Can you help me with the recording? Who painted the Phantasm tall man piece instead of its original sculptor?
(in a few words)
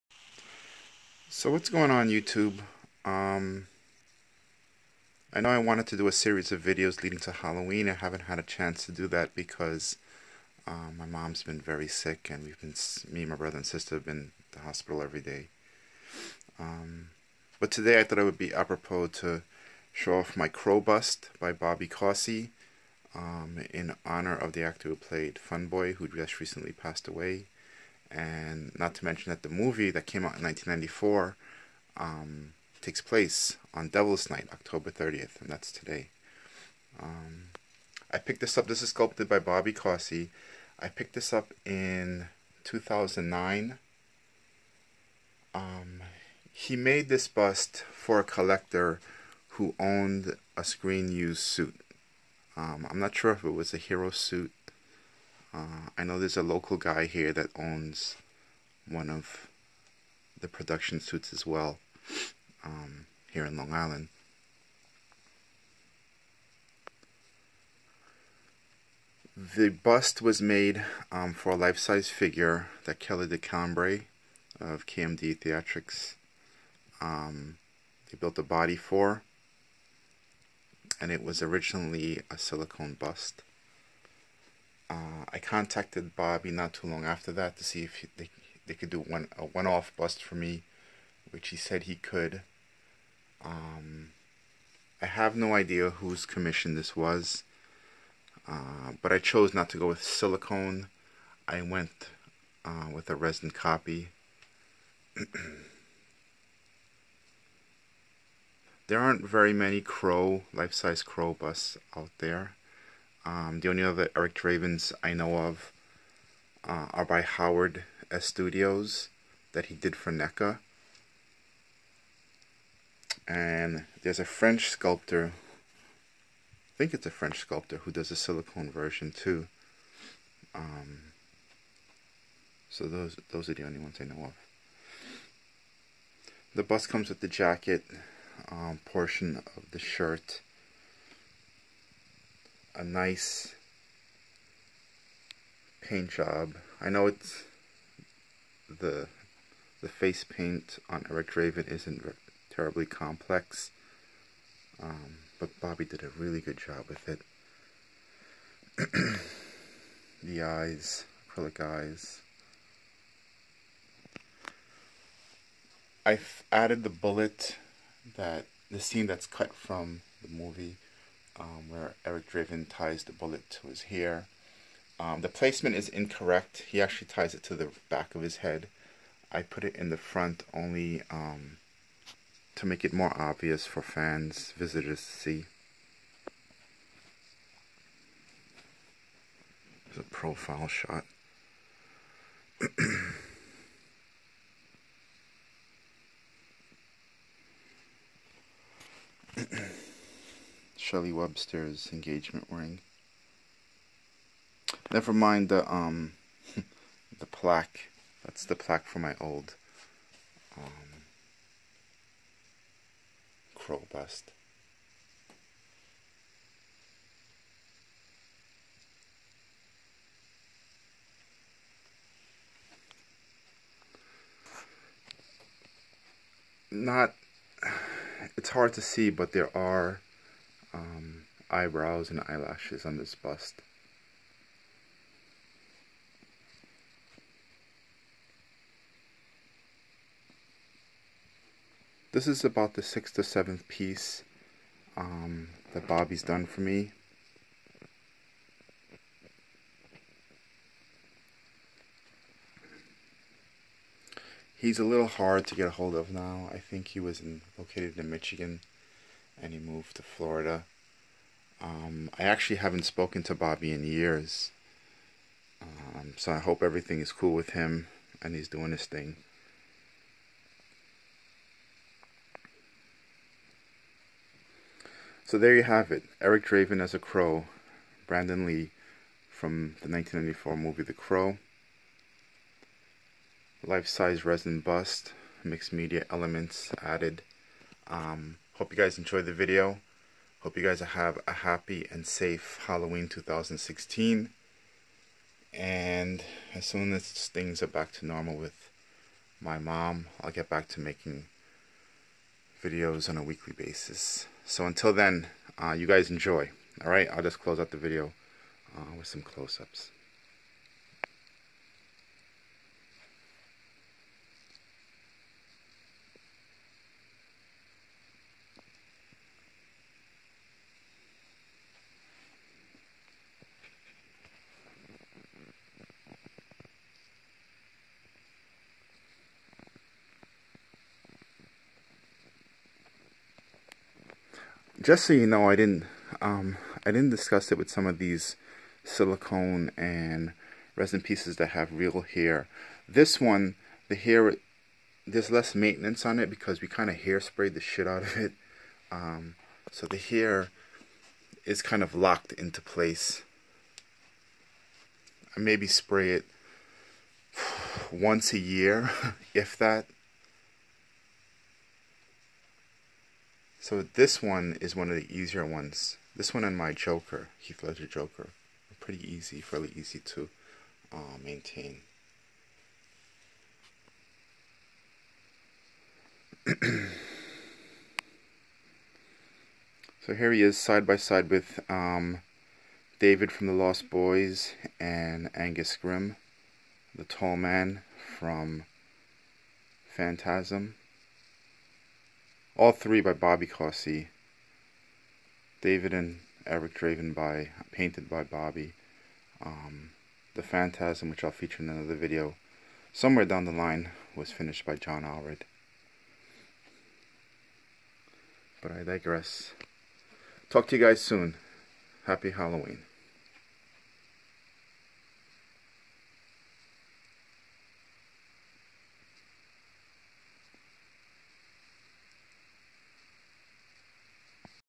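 John Alred.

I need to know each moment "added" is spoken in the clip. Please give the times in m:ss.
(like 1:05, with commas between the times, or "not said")
2:46, 4:46.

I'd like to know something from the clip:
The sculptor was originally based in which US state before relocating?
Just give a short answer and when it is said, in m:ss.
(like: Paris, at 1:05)
Michigan, at 4:18.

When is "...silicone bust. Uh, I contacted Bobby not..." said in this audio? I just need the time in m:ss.
1:22.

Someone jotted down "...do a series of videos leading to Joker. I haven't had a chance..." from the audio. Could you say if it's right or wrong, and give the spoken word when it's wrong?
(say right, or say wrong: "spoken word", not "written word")
wrong: "Halloween", not "Joker".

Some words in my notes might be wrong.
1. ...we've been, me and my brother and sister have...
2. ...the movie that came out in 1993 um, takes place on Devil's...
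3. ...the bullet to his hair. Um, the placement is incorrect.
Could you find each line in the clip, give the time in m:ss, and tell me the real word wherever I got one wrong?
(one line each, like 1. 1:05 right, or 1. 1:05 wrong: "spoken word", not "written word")
1. 0:12 right
2. 0:29 wrong: "1994", not "1993"
3. 2:53 right.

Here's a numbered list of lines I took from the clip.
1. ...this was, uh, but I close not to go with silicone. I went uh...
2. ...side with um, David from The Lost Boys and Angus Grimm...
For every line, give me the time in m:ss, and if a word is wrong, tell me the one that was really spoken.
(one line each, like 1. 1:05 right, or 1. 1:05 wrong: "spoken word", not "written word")
1. 1:36 wrong: "chose", not "close"
2. 6:20 right.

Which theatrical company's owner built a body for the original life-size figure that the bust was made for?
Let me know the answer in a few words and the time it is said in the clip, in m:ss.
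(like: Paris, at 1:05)
KMD Theatrics, at 1:14.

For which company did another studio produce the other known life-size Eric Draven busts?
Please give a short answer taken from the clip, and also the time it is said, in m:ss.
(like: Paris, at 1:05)
NECA, at 2:00.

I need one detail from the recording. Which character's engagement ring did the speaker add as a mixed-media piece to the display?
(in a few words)
Shelley Webster.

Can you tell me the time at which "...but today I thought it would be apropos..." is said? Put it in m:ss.
0:17.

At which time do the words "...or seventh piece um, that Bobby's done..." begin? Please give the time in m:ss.
4:03.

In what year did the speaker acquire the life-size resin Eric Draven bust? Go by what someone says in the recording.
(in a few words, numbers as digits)
2009.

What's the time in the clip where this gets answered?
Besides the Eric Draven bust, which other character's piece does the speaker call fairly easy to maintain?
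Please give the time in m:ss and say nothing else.
6:07.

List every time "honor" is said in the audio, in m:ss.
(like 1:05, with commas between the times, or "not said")
0:24.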